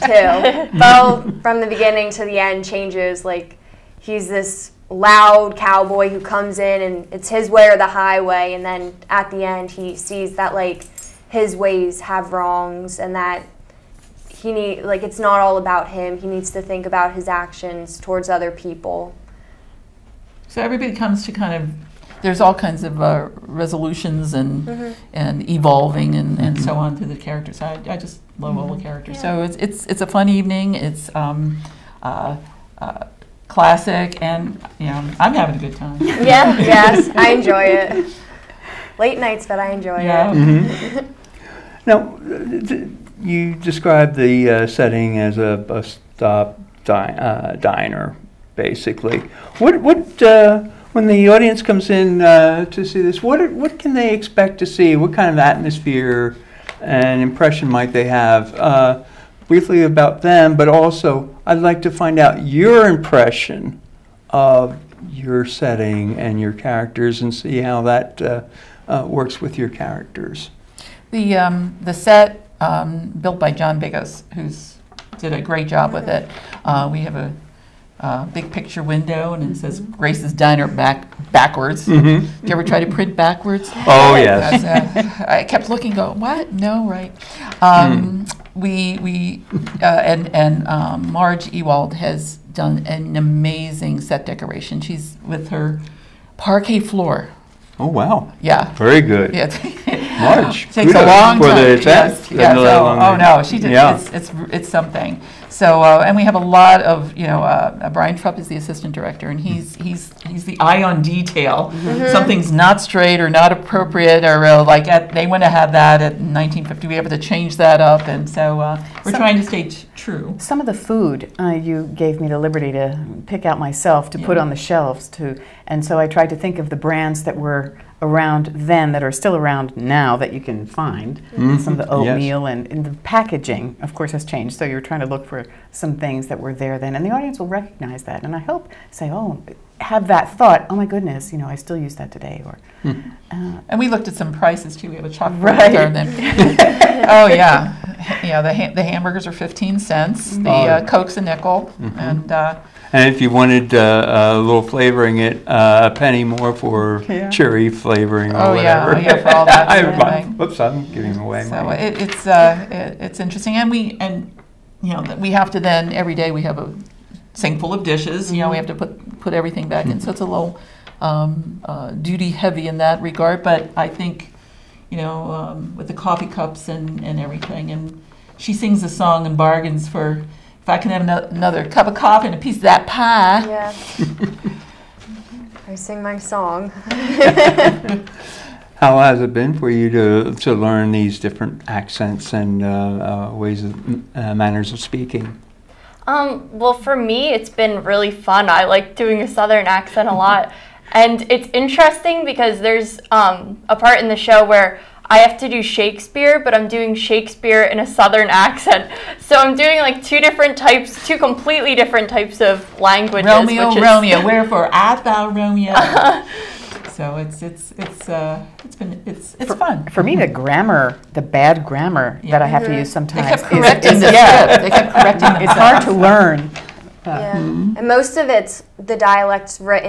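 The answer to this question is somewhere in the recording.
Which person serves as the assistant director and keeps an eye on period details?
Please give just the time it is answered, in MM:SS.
01:47.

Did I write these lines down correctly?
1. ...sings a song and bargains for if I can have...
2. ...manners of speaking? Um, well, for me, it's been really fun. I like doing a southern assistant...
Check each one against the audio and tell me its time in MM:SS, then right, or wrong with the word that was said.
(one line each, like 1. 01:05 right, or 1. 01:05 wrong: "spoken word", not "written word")
1. 02:58 right
2. 03:14 wrong: "accent", not "assistant".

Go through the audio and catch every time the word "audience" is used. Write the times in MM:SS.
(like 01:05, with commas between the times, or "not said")
00:51, 02:17.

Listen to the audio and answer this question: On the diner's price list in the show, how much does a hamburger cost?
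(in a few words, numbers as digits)
15 cents.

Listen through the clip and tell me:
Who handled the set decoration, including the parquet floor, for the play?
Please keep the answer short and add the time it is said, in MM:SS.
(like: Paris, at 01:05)
Marge Ewald, at 01:31.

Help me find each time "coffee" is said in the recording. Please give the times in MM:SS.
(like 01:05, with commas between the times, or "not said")
02:55, 03:01.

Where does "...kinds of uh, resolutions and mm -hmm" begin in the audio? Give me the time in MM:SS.
00:22.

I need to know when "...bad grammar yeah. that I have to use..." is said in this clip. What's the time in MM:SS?
03:41.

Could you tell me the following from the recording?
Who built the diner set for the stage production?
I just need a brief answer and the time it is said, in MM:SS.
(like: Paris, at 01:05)
John Biggos, at 01:13.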